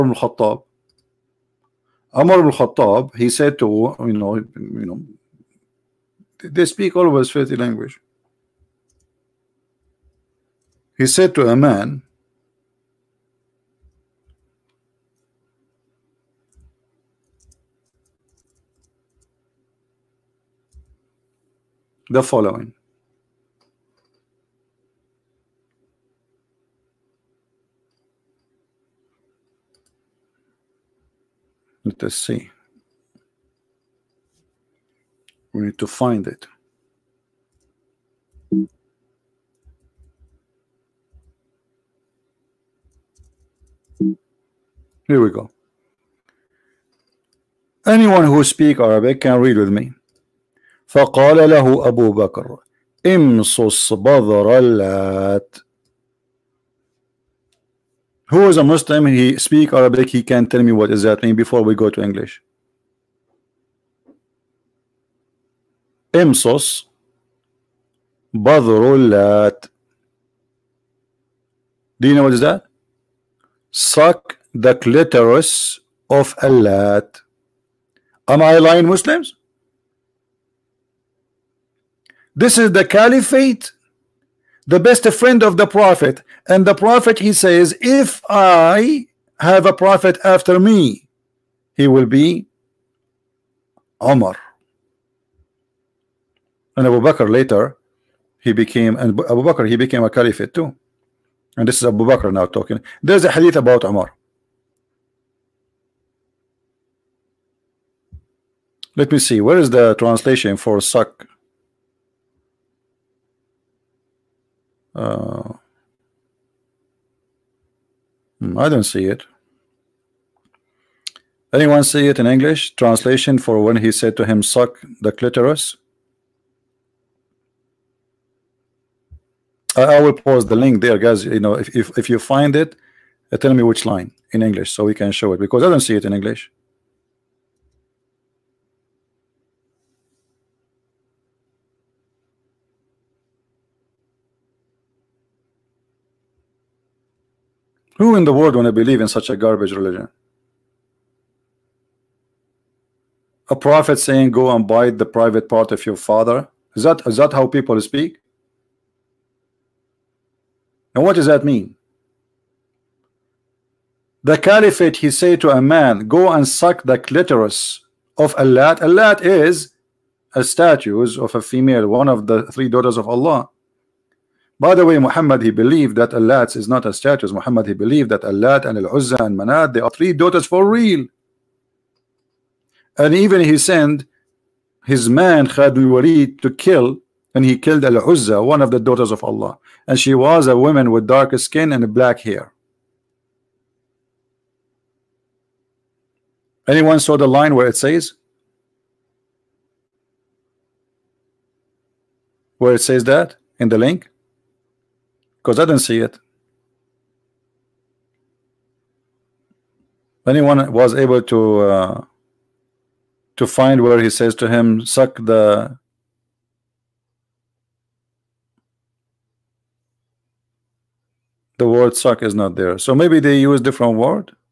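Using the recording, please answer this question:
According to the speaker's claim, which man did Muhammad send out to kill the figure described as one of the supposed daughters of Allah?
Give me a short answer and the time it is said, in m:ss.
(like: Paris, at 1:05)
Khalid Walid, at 3:05.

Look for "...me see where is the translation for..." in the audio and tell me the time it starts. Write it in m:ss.
1:49.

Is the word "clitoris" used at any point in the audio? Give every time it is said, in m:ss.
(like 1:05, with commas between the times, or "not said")
1:14, 2:05, 2:46.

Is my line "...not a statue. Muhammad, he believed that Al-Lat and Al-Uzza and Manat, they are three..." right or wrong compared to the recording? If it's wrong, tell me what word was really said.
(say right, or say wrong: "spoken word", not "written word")
right.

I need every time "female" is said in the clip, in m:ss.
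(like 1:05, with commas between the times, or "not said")
2:51.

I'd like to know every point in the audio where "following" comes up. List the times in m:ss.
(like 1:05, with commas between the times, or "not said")
0:22.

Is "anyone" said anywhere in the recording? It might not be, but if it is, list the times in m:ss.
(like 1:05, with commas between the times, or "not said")
0:47, 2:01, 3:16, 3:30.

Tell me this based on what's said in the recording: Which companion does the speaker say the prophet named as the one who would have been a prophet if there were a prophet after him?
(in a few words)
Omar.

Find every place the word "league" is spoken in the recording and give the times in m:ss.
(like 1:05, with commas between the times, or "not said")
not said.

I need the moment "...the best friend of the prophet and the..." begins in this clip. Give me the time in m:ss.
1:24.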